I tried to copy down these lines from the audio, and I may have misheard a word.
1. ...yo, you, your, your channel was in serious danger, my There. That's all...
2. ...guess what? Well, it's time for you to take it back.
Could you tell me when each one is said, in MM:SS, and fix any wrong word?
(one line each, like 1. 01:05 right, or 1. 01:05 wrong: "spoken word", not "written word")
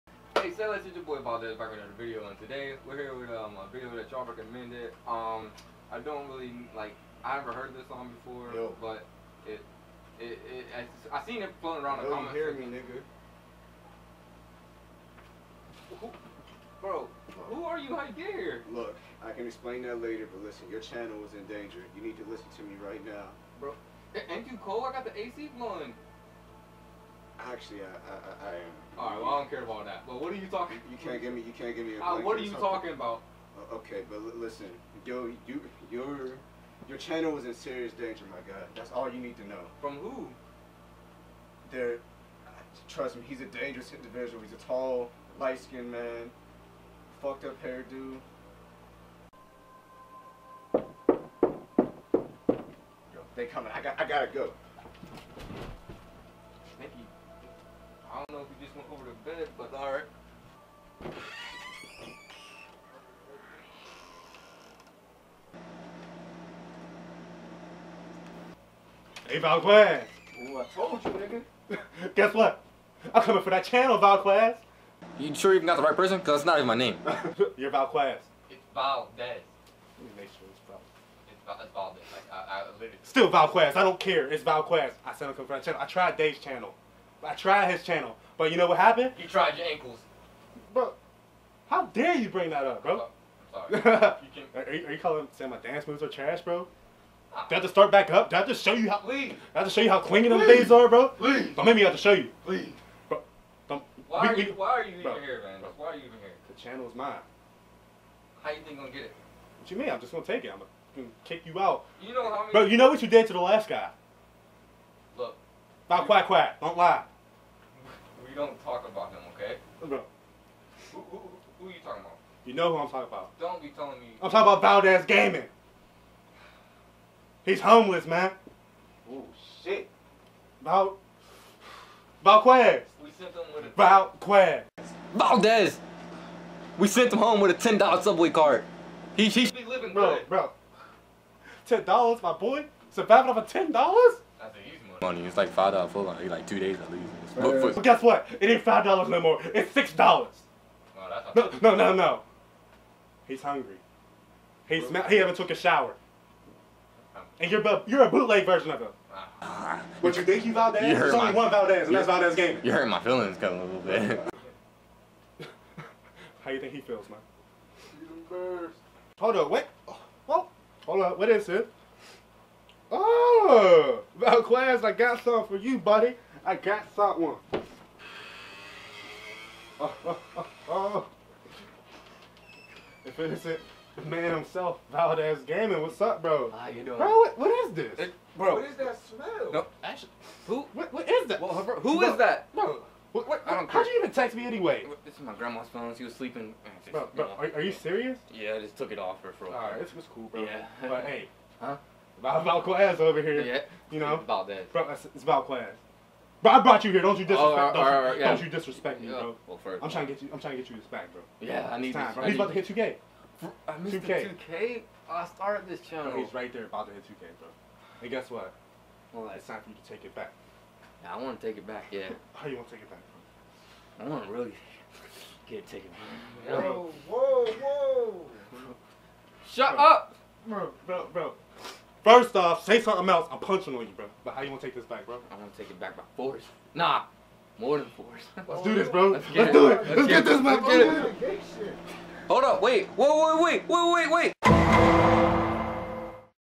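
1. 00:35 wrong: "God", not "There"
2. 03:38 right.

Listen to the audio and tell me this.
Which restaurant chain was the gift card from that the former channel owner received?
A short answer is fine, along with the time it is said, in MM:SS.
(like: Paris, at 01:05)
Subway, at 02:18.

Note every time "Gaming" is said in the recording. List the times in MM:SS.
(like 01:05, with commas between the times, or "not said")
02:05, 03:05.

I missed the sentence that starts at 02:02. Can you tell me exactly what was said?
You know who I'm talking about.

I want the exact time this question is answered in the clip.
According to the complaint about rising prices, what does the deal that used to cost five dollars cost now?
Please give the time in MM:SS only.
02:29.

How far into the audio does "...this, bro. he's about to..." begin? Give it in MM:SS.
03:32.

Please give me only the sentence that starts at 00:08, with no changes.
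but it, it, it, I, I seen it floating around Yo, the comments.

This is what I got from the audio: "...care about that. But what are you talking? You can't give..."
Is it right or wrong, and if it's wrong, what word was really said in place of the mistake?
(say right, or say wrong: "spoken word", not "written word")
right.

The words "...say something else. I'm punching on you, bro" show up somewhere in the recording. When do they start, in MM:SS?
03:52.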